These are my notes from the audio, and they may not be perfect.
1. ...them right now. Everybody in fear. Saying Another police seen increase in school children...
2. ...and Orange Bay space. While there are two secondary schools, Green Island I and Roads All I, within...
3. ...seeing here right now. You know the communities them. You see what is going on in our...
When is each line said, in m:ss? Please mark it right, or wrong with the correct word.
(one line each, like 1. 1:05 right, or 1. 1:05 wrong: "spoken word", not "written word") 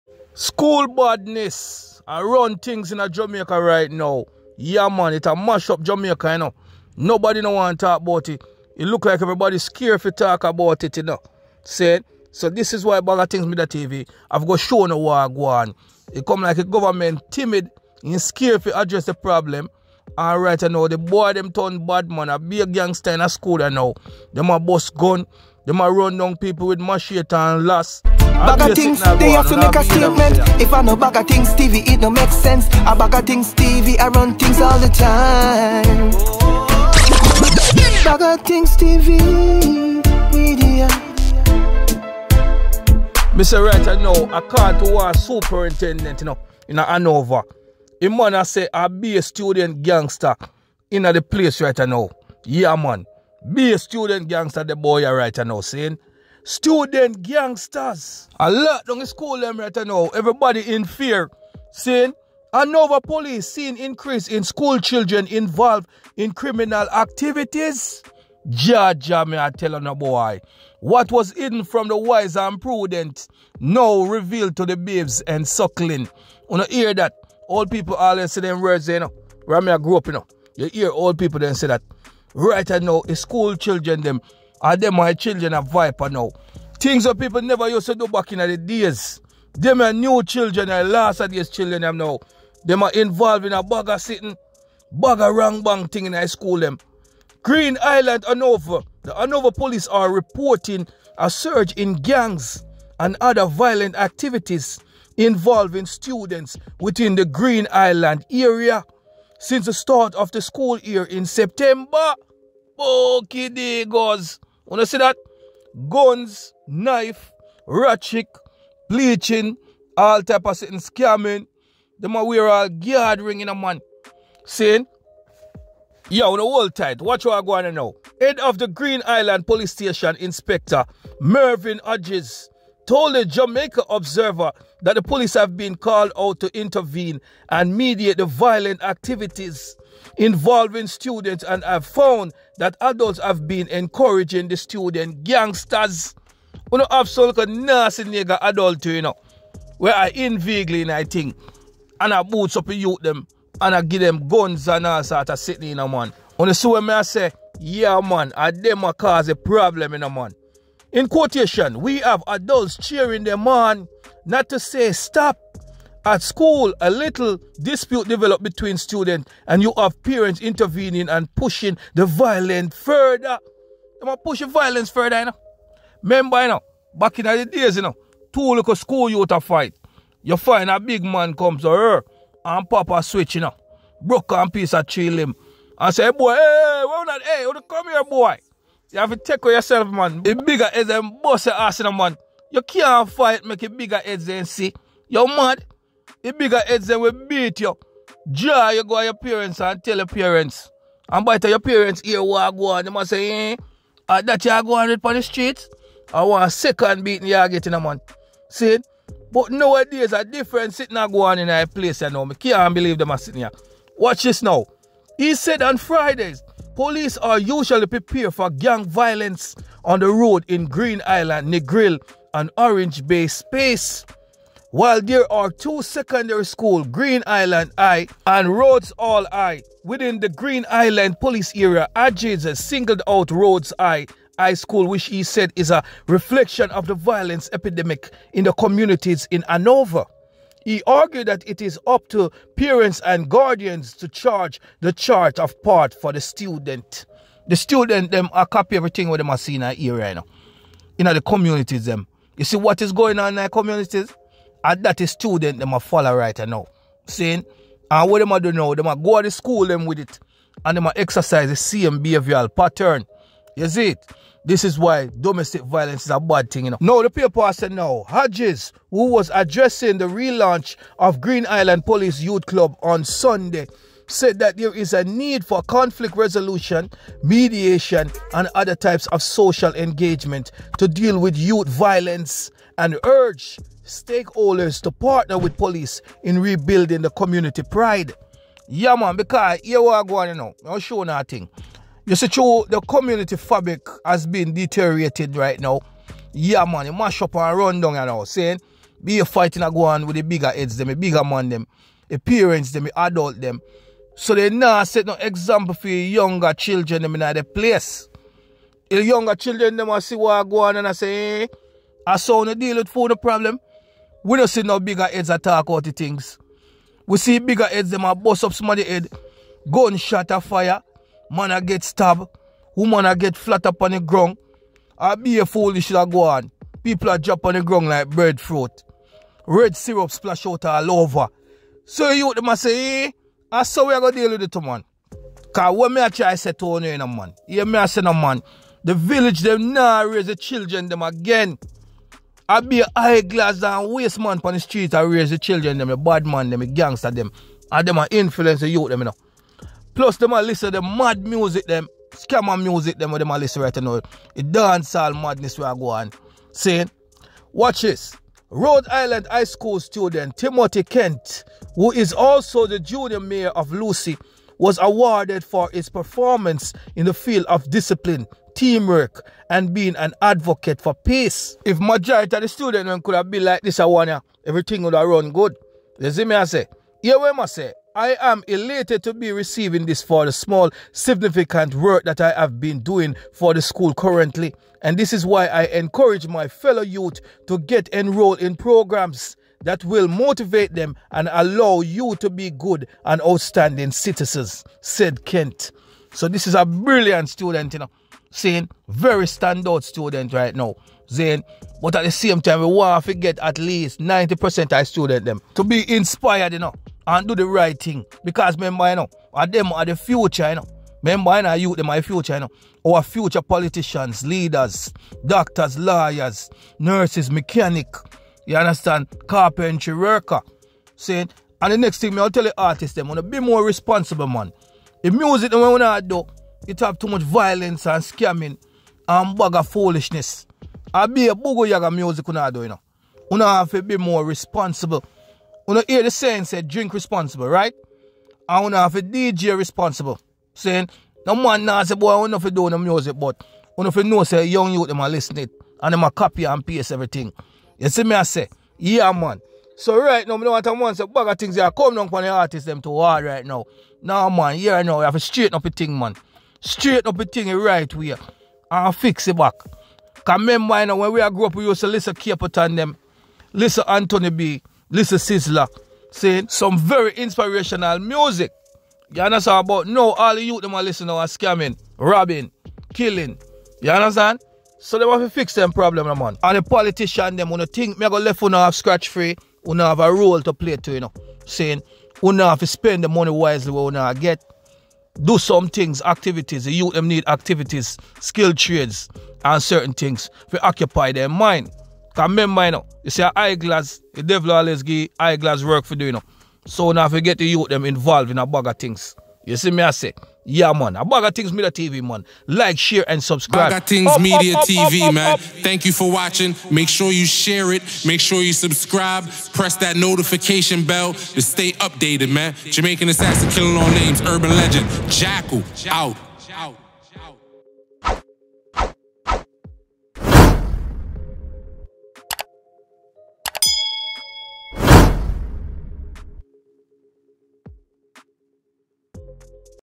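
1. 0:59 right
2. 3:42 right
3. 4:09 right.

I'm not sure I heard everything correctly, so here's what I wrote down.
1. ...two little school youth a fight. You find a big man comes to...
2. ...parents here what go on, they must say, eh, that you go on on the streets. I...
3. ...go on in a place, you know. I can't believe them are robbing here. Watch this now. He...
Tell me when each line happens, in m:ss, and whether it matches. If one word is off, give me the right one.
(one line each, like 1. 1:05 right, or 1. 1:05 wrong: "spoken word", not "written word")
1. 2:58 right
2. 3:21 right
3. 3:31 wrong: "sitting", not "robbing".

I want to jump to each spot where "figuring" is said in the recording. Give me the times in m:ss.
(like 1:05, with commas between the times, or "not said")
not said.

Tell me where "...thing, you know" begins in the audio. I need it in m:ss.
4:26.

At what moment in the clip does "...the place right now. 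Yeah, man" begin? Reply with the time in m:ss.
0:51.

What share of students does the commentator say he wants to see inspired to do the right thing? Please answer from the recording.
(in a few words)
90%.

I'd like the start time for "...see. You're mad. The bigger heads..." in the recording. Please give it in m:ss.
3:14.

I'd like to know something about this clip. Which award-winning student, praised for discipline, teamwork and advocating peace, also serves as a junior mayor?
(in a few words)
Timothy Kent.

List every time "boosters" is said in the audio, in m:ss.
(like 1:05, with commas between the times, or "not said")
not said.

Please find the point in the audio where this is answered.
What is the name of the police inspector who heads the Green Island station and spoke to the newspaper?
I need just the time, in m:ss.
2:11.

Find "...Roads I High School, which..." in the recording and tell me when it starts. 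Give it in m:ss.
3:53.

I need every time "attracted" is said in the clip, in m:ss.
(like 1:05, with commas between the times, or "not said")
not said.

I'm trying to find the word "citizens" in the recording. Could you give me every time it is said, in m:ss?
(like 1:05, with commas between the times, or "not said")
6:33.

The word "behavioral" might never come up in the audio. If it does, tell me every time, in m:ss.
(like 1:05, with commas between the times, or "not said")
4:22.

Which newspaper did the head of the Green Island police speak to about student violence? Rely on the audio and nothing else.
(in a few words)
Jamaica Observer.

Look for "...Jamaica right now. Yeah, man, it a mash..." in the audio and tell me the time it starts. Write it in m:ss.
0:03.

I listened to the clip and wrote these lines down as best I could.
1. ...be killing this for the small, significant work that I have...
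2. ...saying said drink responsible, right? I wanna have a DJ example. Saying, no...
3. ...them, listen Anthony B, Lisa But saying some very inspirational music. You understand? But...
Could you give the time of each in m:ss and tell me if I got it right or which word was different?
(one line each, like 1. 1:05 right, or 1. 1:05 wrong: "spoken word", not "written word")
1. 6:19 wrong: "receiving", not "killing"
2. 7:16 wrong: "responsible", not "example"
3. 7:42 wrong: "Sizzla", not "But".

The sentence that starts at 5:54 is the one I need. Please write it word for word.
The dancehall madness we are going.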